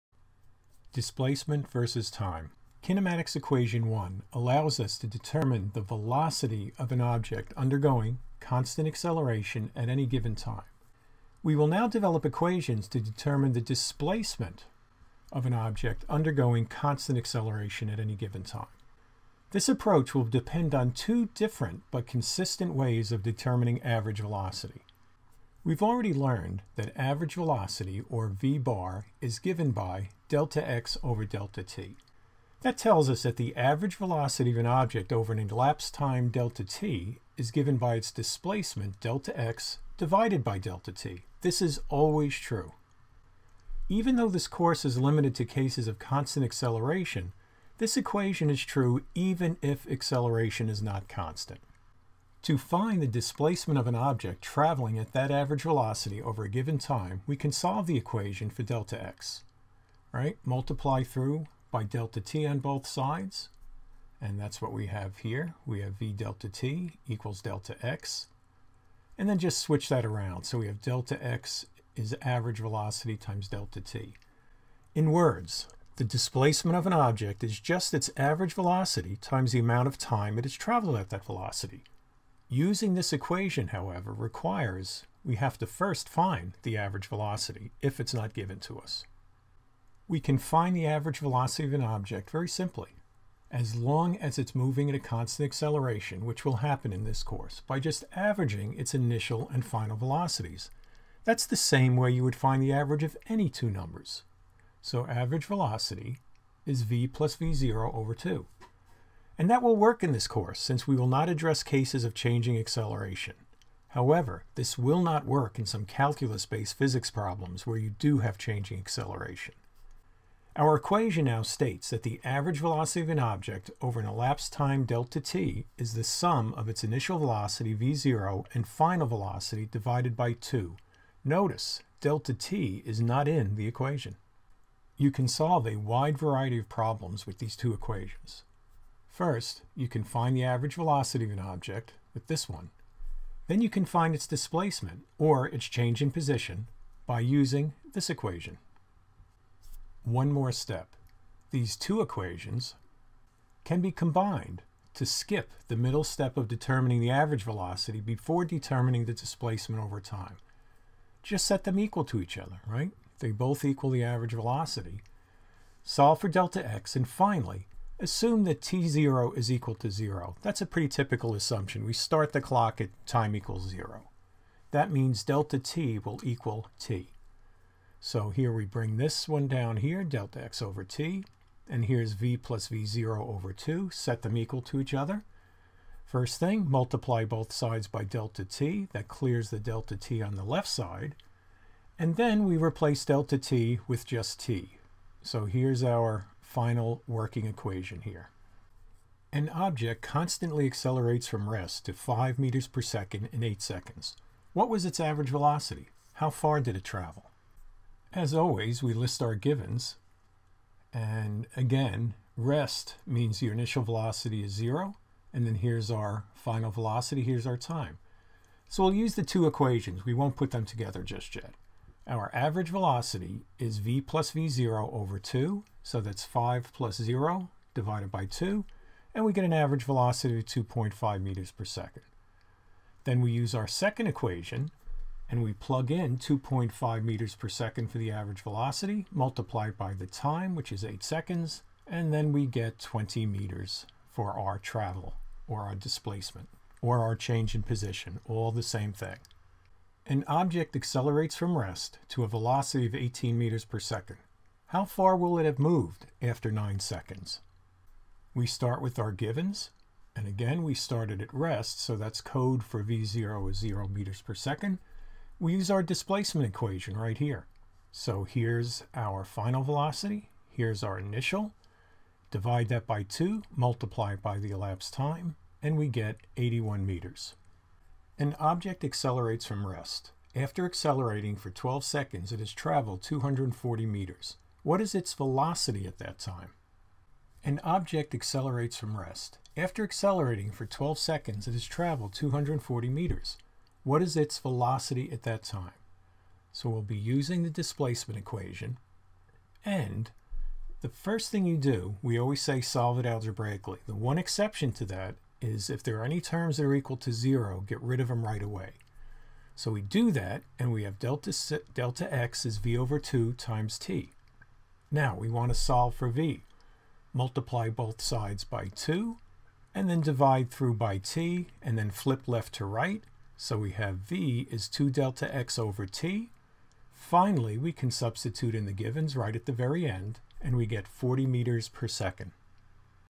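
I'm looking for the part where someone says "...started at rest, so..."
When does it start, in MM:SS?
04:20.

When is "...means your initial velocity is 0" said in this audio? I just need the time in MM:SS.
03:33.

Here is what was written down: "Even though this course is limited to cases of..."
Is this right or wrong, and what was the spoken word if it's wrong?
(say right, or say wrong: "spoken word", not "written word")
right.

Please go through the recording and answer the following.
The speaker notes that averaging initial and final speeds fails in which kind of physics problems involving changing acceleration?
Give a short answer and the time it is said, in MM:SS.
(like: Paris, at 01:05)
calculus-based, at 01:55.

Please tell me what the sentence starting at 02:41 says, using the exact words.
Just set them equal to each other, right?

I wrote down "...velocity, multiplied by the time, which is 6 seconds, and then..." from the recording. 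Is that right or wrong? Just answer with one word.
wrong.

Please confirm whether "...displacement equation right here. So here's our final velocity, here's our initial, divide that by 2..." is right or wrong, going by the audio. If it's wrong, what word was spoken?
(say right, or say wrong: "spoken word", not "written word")
right.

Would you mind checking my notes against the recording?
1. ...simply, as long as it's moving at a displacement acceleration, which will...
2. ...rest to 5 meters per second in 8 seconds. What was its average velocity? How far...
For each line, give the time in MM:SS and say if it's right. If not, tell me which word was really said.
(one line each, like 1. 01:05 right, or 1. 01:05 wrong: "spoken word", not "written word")
1. 01:32 wrong: "constant", not "displacement"
2. 03:21 right.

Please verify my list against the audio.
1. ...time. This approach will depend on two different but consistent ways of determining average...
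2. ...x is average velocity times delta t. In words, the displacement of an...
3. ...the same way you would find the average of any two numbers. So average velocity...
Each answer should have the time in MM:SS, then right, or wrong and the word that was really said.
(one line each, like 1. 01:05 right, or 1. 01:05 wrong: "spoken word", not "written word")
1. 00:18 right
2. 01:11 right
3. 01:41 right.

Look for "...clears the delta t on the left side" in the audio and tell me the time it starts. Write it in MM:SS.
03:09.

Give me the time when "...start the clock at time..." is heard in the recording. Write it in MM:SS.
02:51.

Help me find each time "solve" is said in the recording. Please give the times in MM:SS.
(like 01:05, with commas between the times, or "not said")
00:57, 02:15, 02:45, 05:02, 05:15.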